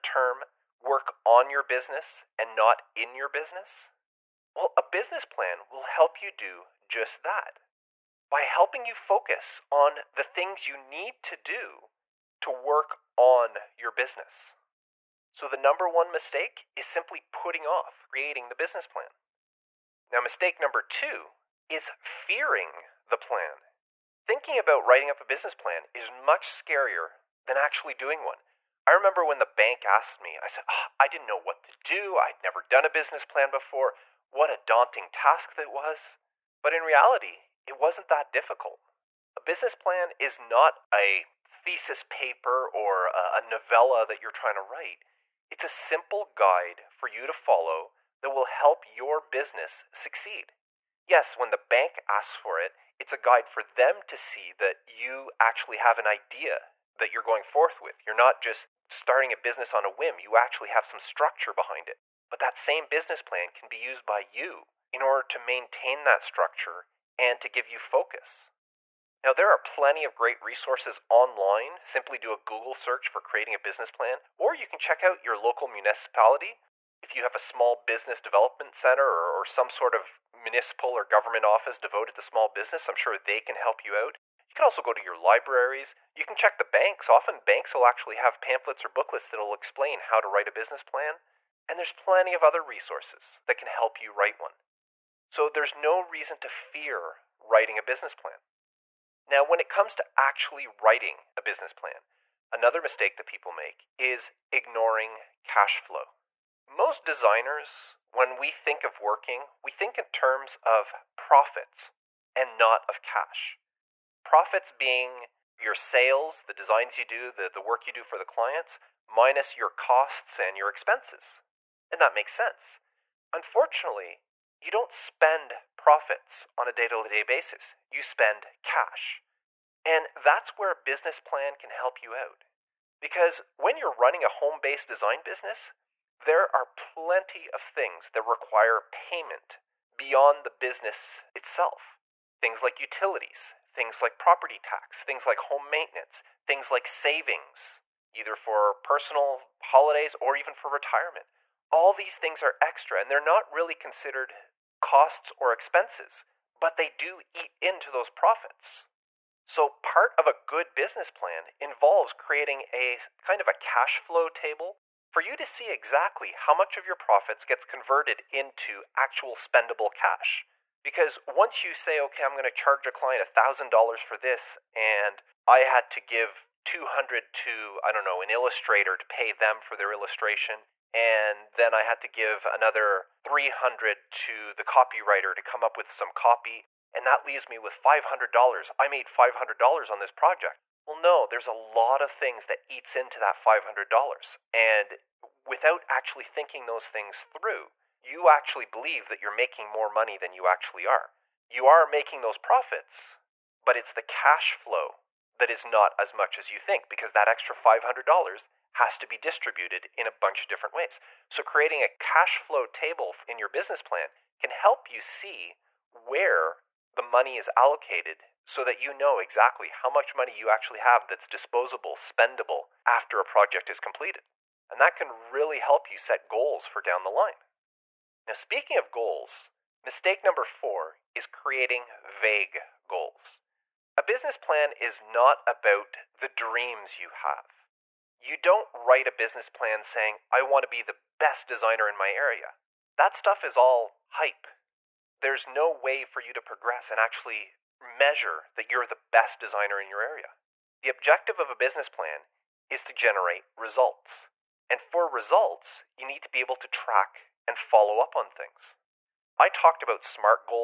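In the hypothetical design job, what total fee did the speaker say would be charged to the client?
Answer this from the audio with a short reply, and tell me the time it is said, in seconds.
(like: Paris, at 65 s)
$1,000, at 173 s.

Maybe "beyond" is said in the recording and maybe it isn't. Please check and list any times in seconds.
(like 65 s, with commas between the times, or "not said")
139 s.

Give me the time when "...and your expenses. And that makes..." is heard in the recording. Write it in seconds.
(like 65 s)
120 s.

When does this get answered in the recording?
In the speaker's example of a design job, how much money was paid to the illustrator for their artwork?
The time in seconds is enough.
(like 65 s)
176 s.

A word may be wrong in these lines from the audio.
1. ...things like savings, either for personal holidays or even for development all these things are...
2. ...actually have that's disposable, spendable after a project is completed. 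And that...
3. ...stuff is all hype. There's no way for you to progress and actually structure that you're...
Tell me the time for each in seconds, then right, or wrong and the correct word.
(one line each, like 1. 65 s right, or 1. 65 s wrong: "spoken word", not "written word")
1. 146 s wrong: "retirement", not "development"
2. 220 s right
3. 243 s wrong: "measure", not "structure".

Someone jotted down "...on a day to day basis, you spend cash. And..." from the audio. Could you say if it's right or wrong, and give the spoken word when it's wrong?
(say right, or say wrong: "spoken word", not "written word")
right.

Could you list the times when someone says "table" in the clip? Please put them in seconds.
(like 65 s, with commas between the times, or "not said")
164 s, 212 s.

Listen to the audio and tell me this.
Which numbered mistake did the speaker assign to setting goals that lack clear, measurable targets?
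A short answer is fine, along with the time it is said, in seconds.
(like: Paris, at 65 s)
4, at 230 s.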